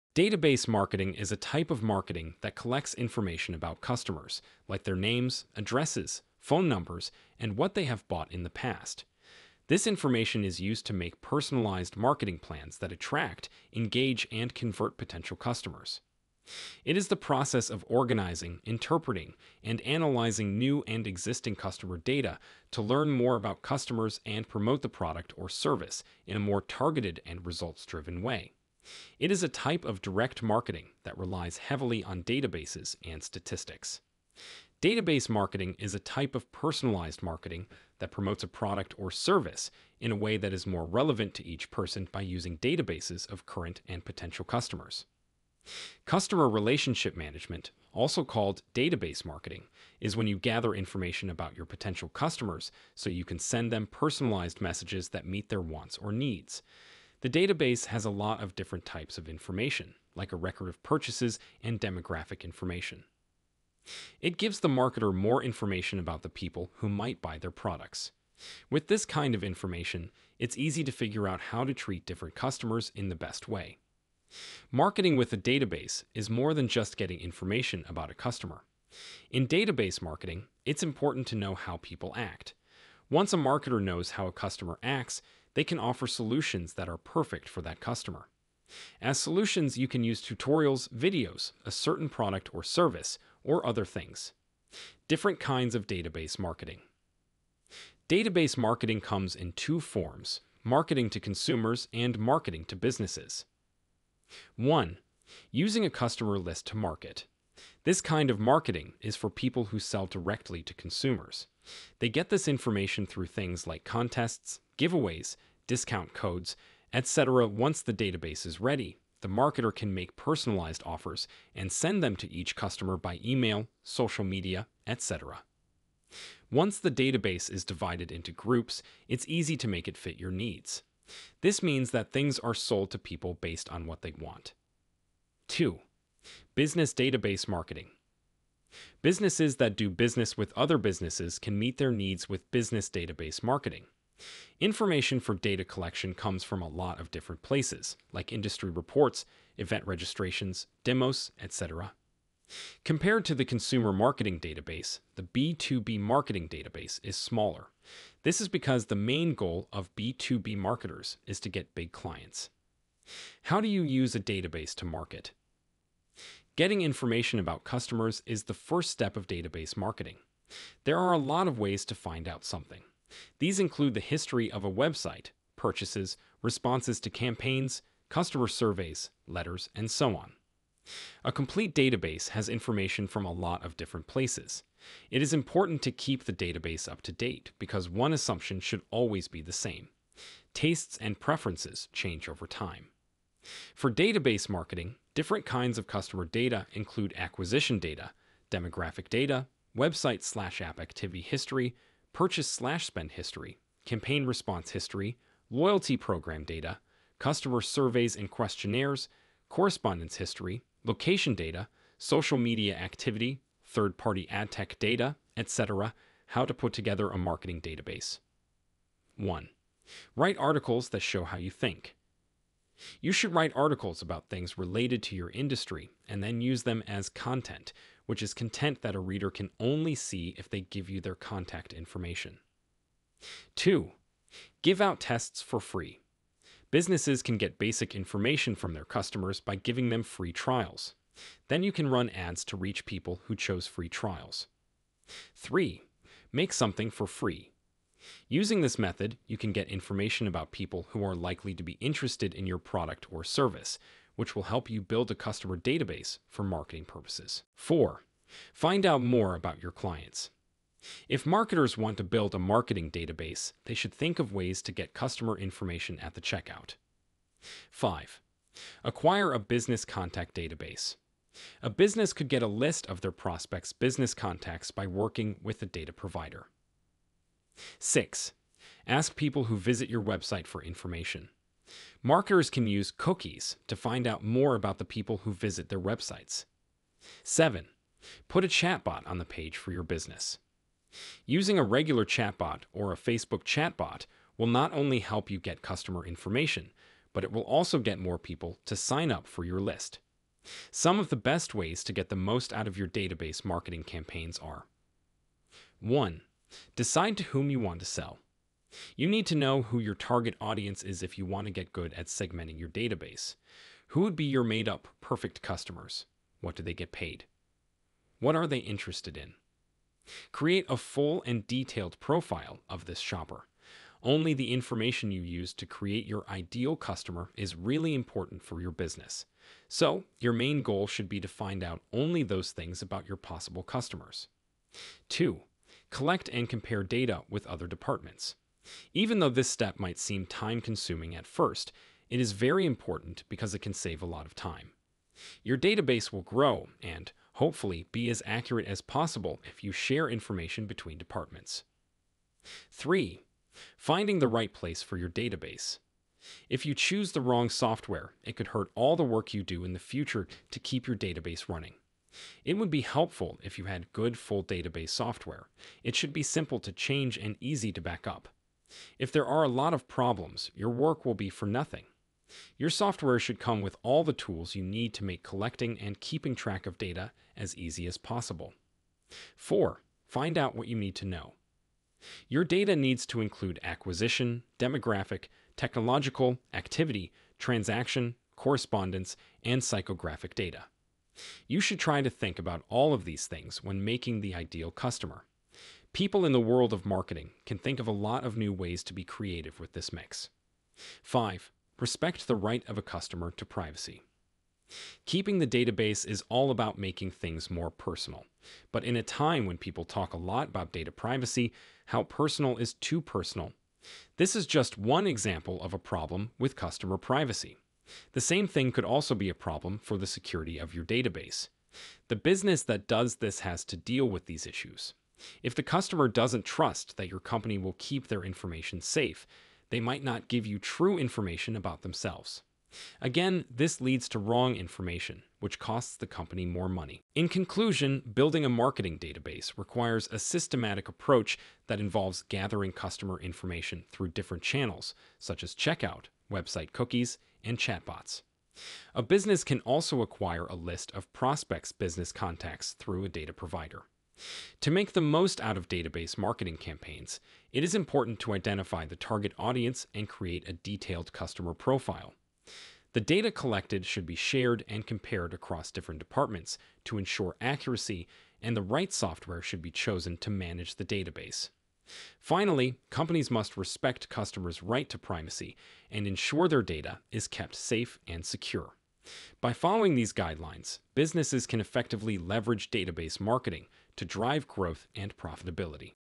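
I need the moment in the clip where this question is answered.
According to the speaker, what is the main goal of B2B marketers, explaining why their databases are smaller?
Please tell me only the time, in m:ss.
2:41.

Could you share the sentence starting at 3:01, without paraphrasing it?
A complete database has information from a lot of different places.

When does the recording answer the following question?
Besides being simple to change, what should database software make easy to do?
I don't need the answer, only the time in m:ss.
6:07.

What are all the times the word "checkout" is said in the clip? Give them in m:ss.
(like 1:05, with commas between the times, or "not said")
4:26, 7:25.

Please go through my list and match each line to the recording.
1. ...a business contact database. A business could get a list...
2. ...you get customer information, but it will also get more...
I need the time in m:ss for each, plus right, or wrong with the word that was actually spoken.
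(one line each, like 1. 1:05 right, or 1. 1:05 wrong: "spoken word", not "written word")
1. 4:29 right
2. 4:55 right.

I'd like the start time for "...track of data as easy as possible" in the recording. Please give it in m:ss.
6:16.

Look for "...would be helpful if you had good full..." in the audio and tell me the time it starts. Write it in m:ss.
6:02.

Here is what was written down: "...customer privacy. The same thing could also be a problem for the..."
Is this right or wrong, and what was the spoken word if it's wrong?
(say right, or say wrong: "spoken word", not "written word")
right.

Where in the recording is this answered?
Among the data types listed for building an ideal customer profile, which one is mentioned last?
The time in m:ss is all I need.
6:29.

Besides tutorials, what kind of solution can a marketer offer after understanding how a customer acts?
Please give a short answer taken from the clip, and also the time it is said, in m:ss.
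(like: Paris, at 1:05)
videos, at 1:30.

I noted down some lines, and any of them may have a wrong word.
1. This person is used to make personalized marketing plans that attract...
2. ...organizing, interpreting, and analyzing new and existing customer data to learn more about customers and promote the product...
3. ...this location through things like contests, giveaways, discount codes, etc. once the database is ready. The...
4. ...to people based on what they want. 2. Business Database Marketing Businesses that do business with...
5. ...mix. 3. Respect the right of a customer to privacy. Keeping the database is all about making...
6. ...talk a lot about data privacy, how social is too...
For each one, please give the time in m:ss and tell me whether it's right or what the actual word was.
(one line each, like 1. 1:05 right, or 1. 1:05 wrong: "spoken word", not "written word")
1. 0:09 wrong: "information", not "person"
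2. 0:17 right
3. 1:52 wrong: "information", not "location"
4. 2:12 right
5. 6:39 wrong: "5", not "3"
6. 6:49 wrong: "personal", not "social".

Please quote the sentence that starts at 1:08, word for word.
With this kind of information, it's easy to figure out how to treat different customers in the best way.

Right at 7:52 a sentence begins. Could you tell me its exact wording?
Finally, companies must respect customers' right to privacy and ensure their data is kept safe and secure.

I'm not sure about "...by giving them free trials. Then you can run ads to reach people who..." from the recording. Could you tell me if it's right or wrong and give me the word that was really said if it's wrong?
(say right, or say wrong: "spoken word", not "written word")
right.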